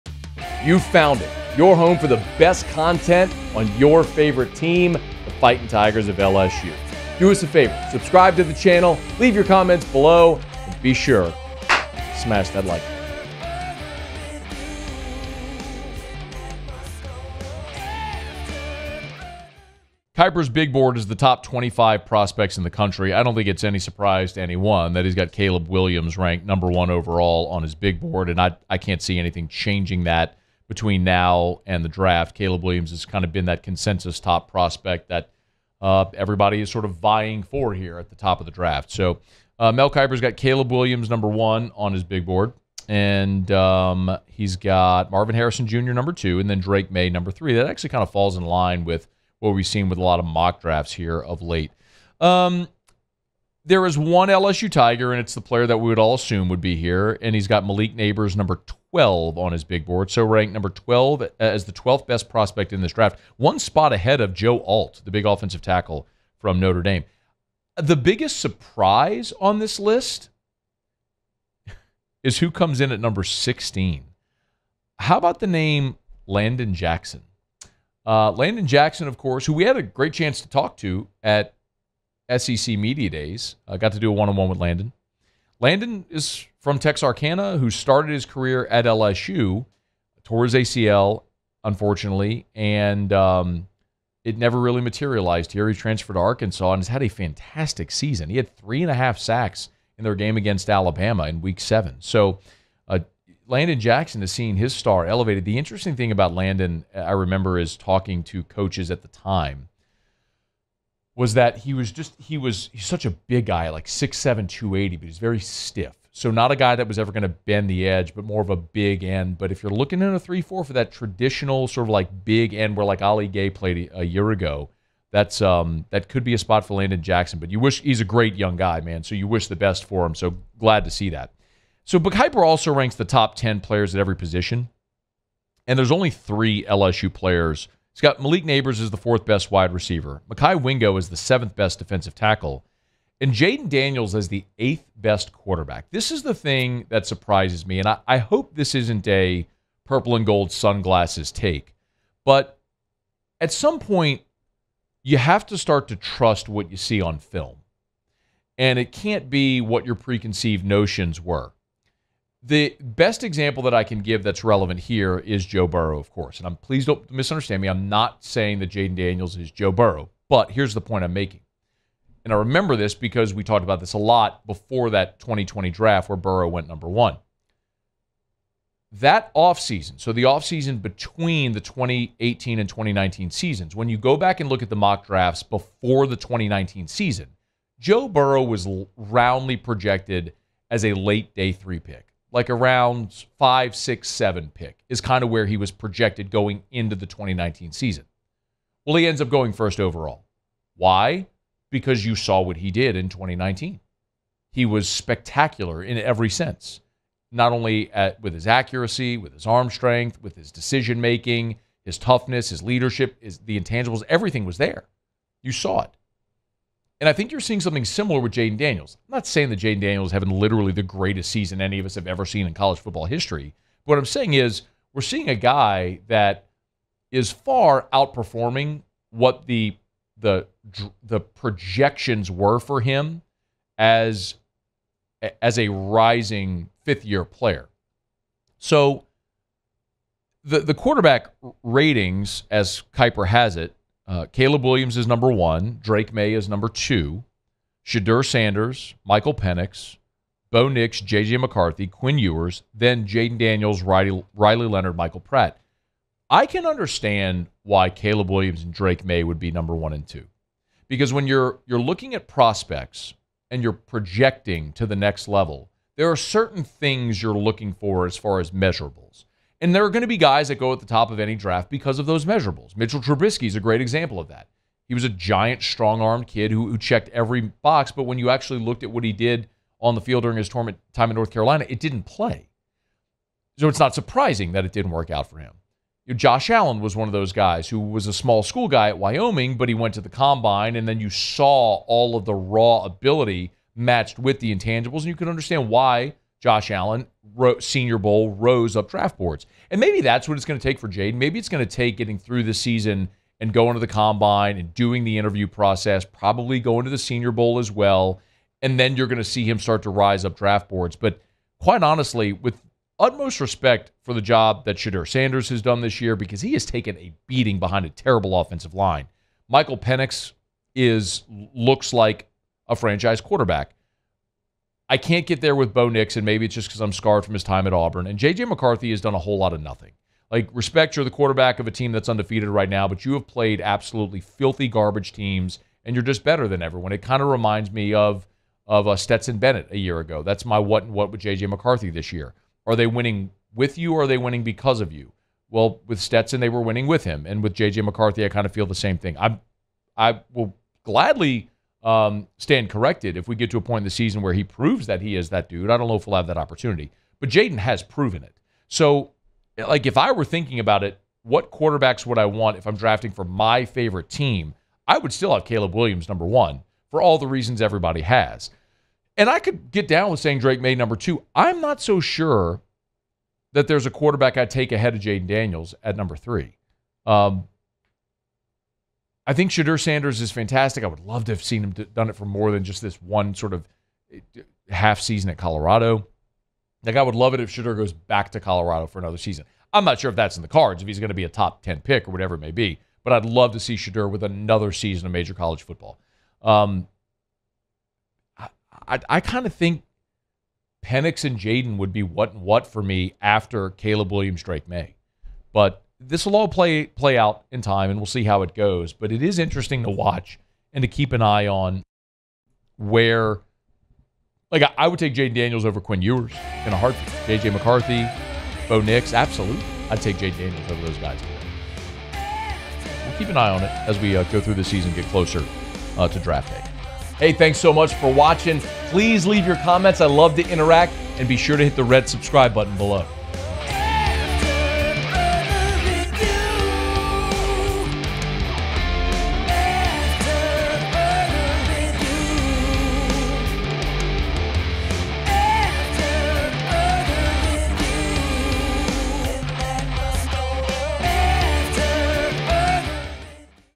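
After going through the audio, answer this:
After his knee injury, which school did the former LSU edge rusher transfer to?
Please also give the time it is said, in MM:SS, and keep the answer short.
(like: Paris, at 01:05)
Arkansas, at 01:36.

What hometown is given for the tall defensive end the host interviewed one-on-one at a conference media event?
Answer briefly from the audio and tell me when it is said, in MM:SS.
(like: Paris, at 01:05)
Texarkana, at 01:26.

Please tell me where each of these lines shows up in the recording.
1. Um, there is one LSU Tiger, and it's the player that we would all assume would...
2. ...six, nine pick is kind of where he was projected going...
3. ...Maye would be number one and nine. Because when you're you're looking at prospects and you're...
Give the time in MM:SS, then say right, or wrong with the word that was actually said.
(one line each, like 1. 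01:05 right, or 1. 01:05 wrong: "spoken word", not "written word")
1. 00:52 right
2. 03:13 wrong: "seven", not "nine"
3. 04:19 wrong: "two", not "nine".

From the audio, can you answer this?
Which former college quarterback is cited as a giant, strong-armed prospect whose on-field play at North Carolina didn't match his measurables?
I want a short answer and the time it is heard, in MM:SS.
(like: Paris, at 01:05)
Mitchell Trubisky, at 04:32.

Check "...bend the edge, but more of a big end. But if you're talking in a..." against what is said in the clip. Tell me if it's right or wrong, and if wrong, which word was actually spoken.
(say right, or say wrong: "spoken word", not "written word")
wrong: "looking", not "talking".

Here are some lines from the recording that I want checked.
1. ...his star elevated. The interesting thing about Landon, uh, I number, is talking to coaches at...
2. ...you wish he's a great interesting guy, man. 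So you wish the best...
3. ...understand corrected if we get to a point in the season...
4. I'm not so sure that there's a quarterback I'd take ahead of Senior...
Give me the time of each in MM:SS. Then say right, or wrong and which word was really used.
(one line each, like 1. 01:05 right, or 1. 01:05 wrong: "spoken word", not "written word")
1. 01:44 wrong: "remember", not "number"
2. 02:07 wrong: "young", not "interesting"
3. 05:52 wrong: "stand", not "understand"
4. 06:11 wrong: "Jayden", not "Senior".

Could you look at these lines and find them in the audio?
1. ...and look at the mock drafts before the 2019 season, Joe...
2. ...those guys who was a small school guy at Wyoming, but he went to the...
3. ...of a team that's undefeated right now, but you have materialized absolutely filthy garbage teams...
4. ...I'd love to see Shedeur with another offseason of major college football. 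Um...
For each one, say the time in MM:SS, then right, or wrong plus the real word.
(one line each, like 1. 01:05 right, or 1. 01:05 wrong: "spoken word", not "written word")
1. 03:04 right
2. 04:47 right
3. 05:31 wrong: "played", not "materialized"
4. 06:33 wrong: "season", not "offseason".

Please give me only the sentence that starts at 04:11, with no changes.
McCarthy, Quinn Ewers, then Jayden Daniels, Riley, Riley Leonard, Michael Pratt.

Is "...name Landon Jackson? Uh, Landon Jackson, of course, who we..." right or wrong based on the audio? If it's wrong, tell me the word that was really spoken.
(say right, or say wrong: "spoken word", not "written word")
right.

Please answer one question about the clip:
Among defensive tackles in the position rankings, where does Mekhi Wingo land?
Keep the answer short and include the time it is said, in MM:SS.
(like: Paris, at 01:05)
7th, at 02:21.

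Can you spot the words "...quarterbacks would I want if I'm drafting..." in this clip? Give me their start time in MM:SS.
06:01.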